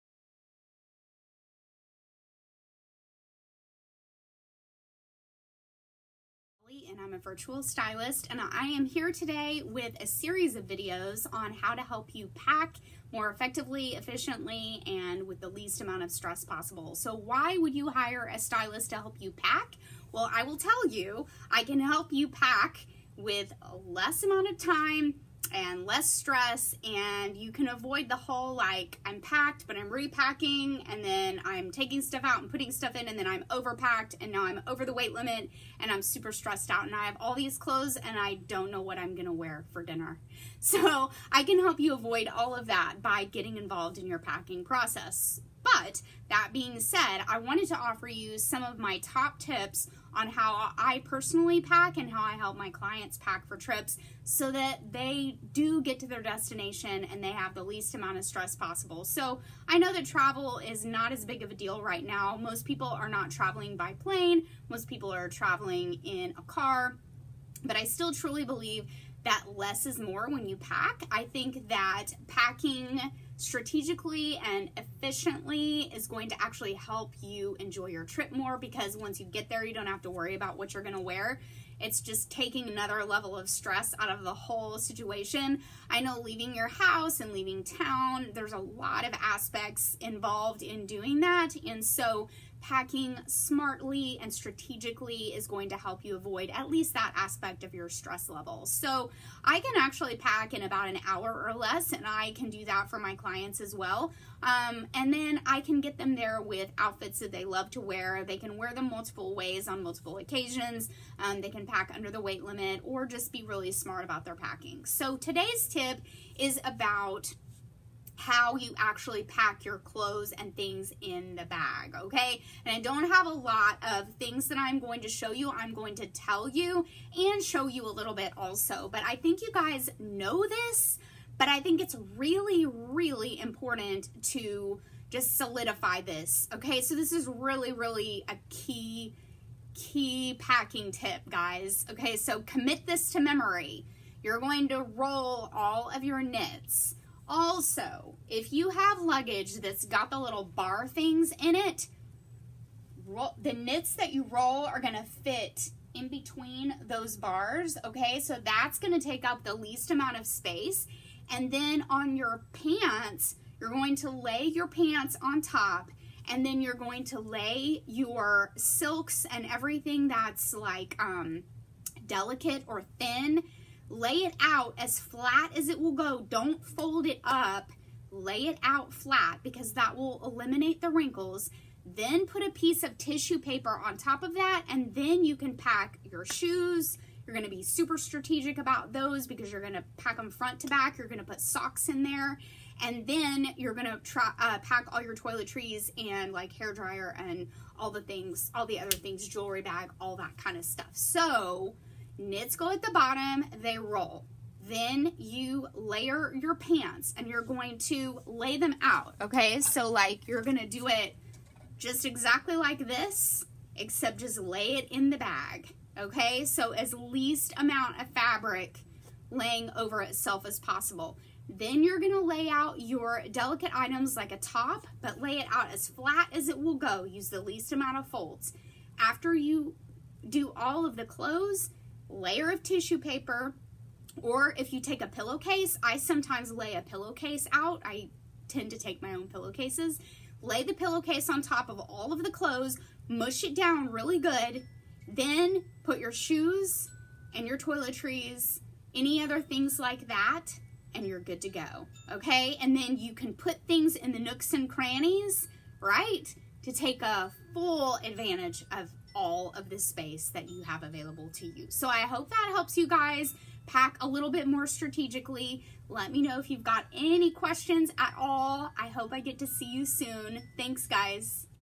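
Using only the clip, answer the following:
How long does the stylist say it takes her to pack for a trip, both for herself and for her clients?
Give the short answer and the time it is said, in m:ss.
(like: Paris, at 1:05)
about an hour or less, at 1:40.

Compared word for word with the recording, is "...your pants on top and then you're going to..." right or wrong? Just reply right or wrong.
right.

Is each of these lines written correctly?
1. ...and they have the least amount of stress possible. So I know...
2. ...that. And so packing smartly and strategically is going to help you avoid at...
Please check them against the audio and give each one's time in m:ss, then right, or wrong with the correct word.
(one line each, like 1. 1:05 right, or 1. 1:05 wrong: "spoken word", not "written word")
1. 0:57 right
2. 1:31 right.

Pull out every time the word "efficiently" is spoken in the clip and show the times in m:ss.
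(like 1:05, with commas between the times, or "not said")
0:13, 1:14.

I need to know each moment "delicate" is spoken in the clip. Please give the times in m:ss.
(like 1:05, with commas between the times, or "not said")
2:52, 3:43.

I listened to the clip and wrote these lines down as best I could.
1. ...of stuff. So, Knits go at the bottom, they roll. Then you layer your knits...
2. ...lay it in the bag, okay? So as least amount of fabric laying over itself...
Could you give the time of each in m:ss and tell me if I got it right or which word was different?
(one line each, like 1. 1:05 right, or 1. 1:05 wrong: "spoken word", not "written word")
1. 3:20 wrong: "pants", not "knits"
2. 3:34 right.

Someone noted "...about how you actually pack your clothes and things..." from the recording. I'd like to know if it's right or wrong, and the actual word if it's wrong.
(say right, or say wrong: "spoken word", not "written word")
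right.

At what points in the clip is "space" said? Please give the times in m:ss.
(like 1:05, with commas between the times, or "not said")
2:40, 4:19.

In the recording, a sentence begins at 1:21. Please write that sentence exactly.
It's just taking another level of stress out of the whole situation.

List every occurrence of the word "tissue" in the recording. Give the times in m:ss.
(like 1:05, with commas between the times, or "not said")
3:02, 3:52.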